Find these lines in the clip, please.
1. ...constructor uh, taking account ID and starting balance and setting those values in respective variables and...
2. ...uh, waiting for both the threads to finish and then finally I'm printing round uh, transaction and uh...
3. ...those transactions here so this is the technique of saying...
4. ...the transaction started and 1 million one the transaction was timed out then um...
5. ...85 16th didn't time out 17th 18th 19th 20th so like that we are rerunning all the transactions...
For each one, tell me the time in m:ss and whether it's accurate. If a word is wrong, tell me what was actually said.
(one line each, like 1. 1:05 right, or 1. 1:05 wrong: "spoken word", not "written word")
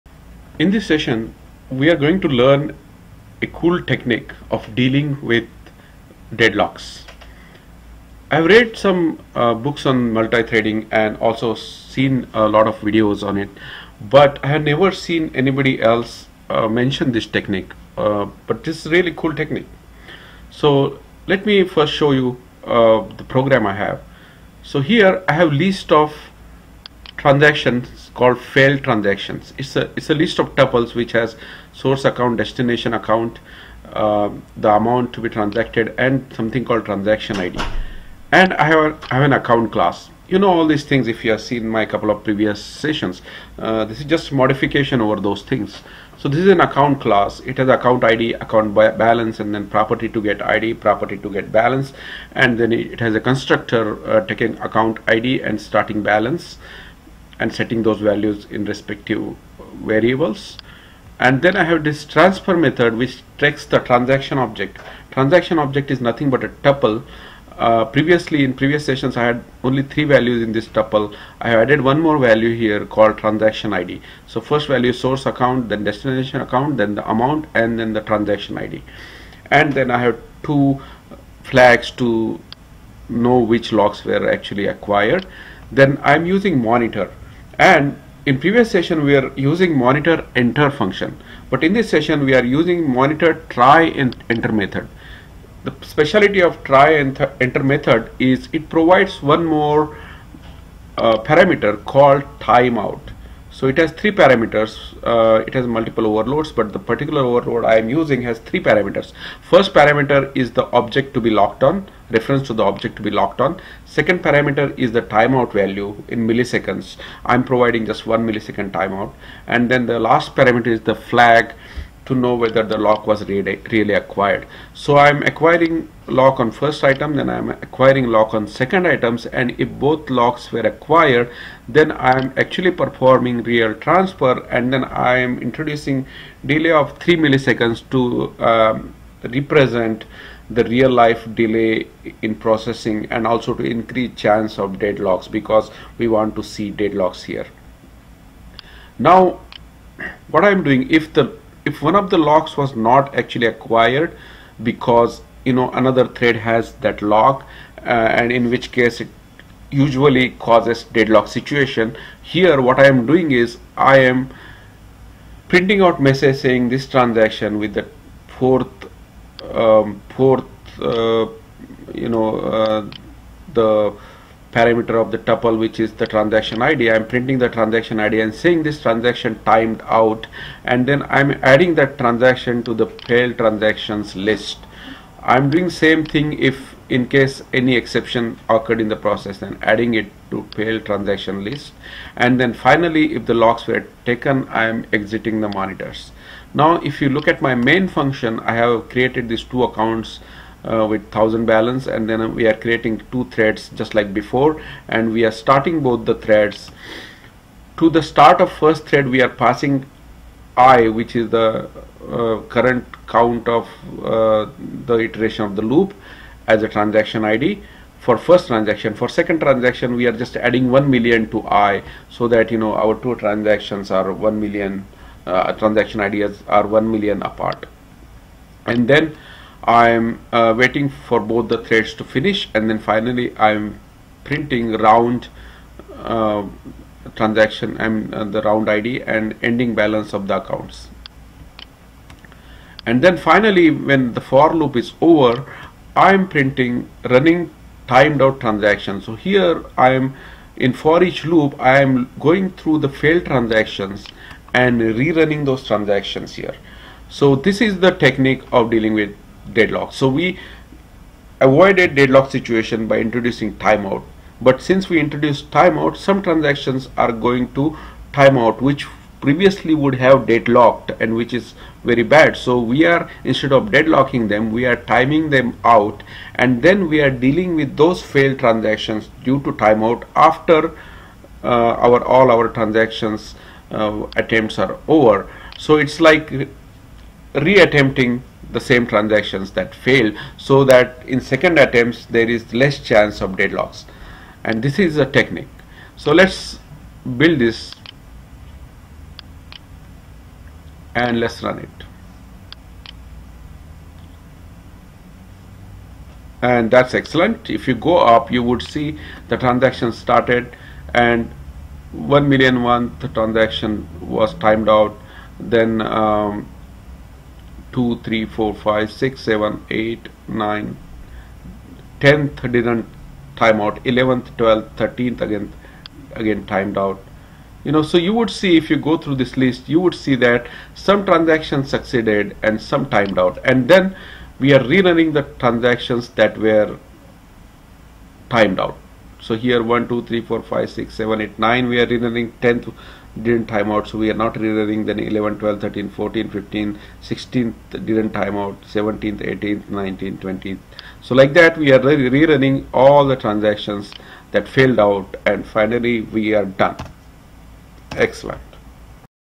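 1. 0:53 right
2. 3:50 right
3. 4:15 wrong: "dealing", not "saying"
4. 5:09 right
5. 5:46 wrong: "15", not "85".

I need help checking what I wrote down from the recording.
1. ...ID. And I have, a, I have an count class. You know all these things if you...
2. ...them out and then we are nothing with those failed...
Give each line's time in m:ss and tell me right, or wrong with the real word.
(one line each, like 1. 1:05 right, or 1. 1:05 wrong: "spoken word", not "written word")
1. 0:37 wrong: "account", not "count"
2. 4:35 wrong: "dealing", not "nothing".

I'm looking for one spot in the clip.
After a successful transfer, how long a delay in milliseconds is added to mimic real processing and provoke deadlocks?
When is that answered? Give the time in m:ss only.
2:16.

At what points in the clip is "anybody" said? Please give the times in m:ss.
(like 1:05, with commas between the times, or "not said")
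0:15.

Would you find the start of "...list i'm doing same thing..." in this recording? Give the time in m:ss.
3:04.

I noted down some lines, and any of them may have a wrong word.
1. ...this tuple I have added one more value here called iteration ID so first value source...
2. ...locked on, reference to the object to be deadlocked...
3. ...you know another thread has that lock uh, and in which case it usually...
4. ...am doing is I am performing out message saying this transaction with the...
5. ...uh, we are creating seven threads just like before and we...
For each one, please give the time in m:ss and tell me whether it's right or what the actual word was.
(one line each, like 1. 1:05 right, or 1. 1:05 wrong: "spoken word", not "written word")
1. 1:10 wrong: "transaction", not "iteration"
2. 1:51 wrong: "locked", not "deadlocked"
3. 2:35 right
4. 2:42 wrong: "printing", not "performing"
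5. 3:22 wrong: "two", not "seven".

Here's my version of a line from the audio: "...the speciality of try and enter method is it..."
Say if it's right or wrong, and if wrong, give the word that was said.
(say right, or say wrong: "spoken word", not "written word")
right.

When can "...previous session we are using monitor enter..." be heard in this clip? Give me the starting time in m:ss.
1:28.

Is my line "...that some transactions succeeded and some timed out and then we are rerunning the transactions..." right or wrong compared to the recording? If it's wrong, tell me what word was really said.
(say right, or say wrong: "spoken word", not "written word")
right.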